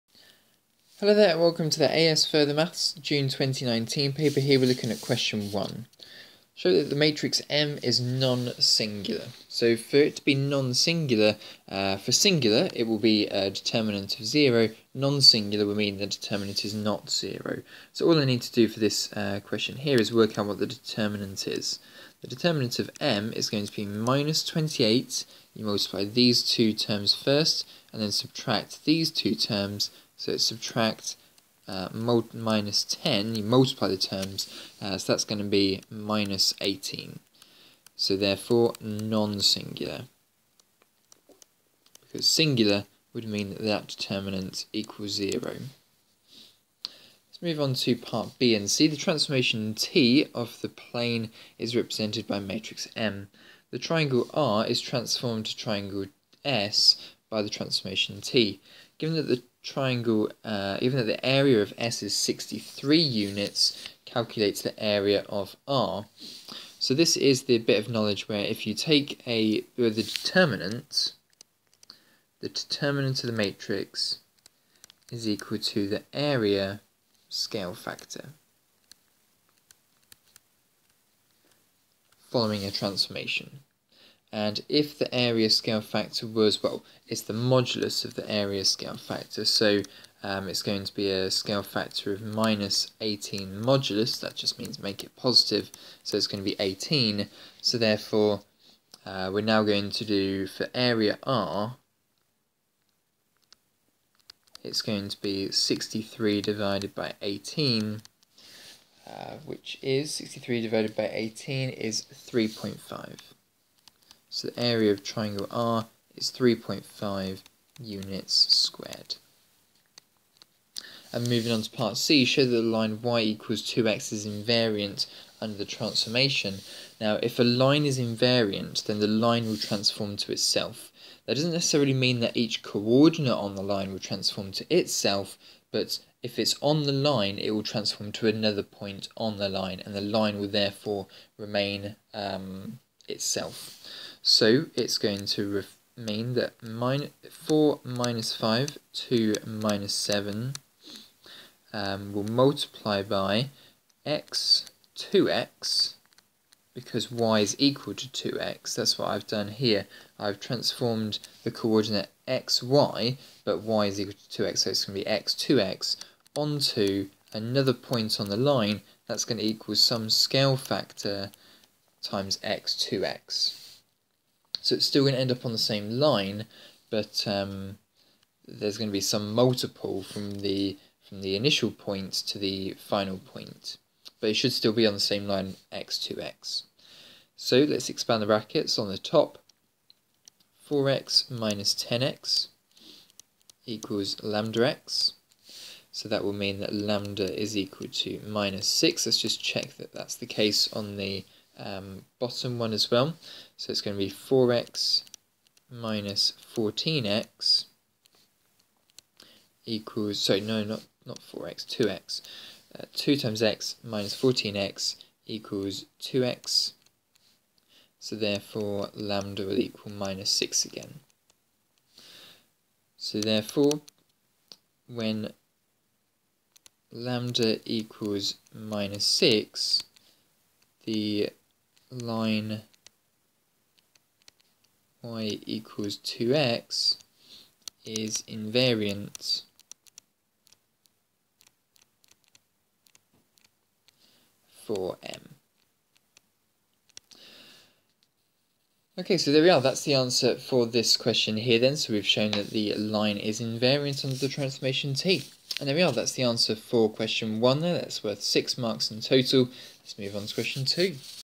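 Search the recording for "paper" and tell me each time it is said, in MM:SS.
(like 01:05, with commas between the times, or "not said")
00:04.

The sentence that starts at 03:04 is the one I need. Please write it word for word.
But it should still be on the same line x to x.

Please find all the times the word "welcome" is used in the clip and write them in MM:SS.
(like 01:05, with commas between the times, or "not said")
00:01.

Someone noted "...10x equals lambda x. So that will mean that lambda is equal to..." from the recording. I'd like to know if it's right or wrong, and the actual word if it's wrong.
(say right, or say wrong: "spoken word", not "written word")
right.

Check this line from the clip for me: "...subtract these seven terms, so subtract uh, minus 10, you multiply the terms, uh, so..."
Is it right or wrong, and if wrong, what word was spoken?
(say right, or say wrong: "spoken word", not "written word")
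wrong: "two", not "seven".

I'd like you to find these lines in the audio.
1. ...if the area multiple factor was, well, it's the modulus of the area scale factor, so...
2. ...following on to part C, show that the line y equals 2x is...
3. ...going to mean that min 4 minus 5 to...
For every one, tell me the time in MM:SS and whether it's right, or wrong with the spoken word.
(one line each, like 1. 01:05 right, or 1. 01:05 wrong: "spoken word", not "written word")
1. 01:24 wrong: "scale", not "multiple"
2. 02:01 wrong: "moving", not "following"
3. 02:24 right.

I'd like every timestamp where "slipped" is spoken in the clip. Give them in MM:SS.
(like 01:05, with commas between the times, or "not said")
not said.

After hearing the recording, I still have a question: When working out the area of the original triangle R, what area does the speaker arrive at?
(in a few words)
3.5 units squared.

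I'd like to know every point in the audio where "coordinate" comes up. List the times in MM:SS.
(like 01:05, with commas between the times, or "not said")
02:12, 02:41.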